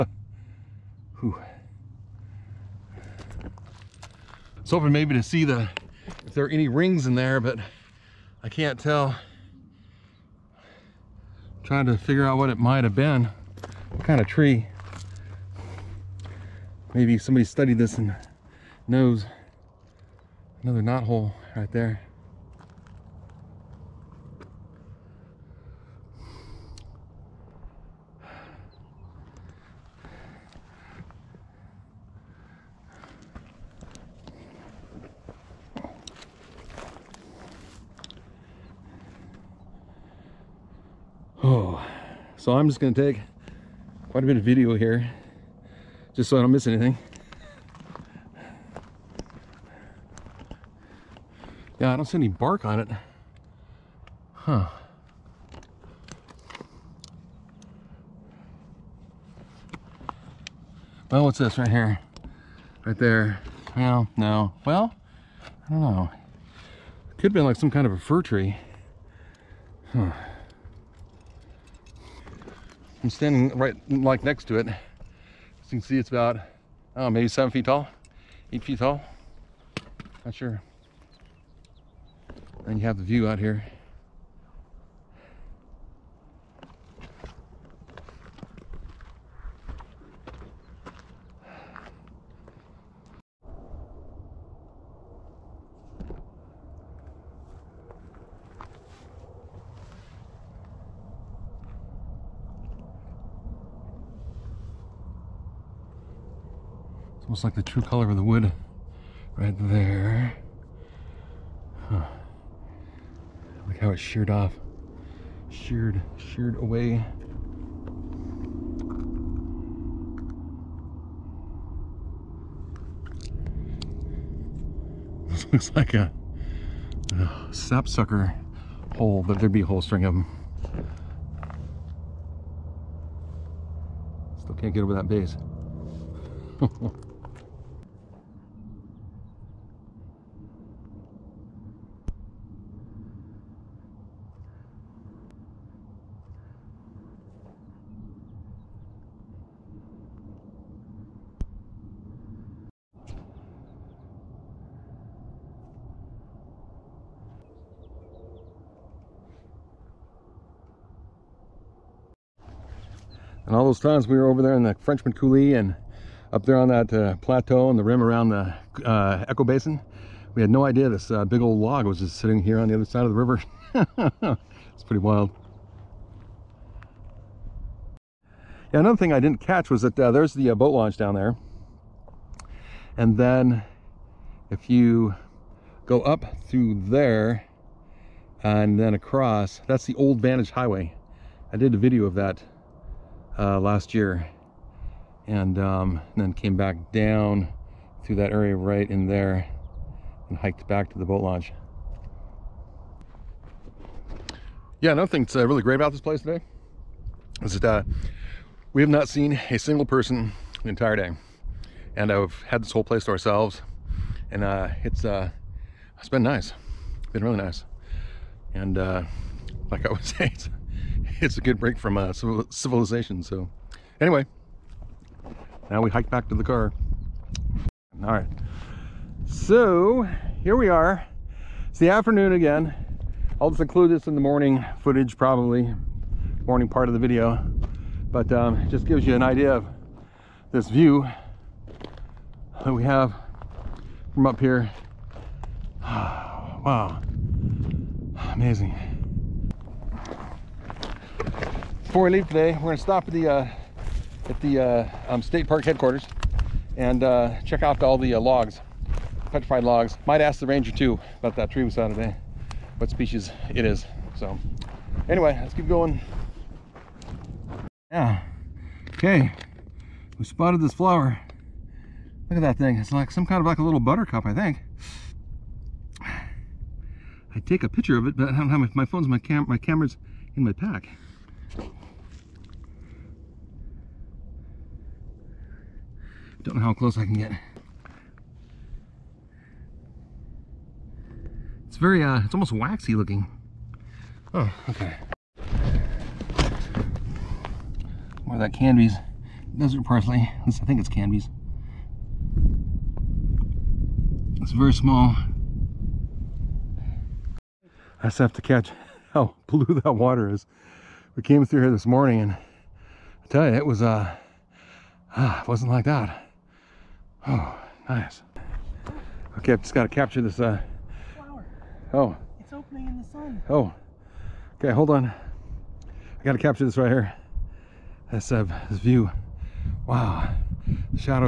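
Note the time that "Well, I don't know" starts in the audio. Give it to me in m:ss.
1:04.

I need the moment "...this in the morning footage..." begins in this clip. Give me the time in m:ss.
3:53.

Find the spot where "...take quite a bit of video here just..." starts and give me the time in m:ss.
0:42.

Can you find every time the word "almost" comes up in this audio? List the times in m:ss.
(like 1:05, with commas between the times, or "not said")
1:47, 4:52.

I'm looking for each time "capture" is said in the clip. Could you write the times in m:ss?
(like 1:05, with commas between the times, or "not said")
5:19, 5:26.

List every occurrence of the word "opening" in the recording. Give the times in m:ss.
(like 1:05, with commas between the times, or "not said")
5:22.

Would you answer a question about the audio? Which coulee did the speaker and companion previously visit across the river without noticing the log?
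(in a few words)
Frenchman Coulee.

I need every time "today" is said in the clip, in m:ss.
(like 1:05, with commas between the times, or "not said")
3:26, 4:12, 4:21.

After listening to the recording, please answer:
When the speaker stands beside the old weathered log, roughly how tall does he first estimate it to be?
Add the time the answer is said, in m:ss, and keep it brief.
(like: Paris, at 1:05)
7 feet, at 1:17.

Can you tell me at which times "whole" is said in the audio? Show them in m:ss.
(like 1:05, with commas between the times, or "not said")
2:09, 3:32.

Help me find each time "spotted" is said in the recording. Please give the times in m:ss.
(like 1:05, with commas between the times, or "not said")
4:30.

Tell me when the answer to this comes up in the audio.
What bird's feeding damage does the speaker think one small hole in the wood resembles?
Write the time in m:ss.
2:07.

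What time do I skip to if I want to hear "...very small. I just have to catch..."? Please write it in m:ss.
5:04.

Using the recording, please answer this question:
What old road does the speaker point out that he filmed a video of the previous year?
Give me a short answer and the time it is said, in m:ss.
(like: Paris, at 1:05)
Old Vantage Highway, at 3:09.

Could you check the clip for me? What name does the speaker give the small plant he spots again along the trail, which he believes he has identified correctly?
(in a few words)
Canby's desert parsley.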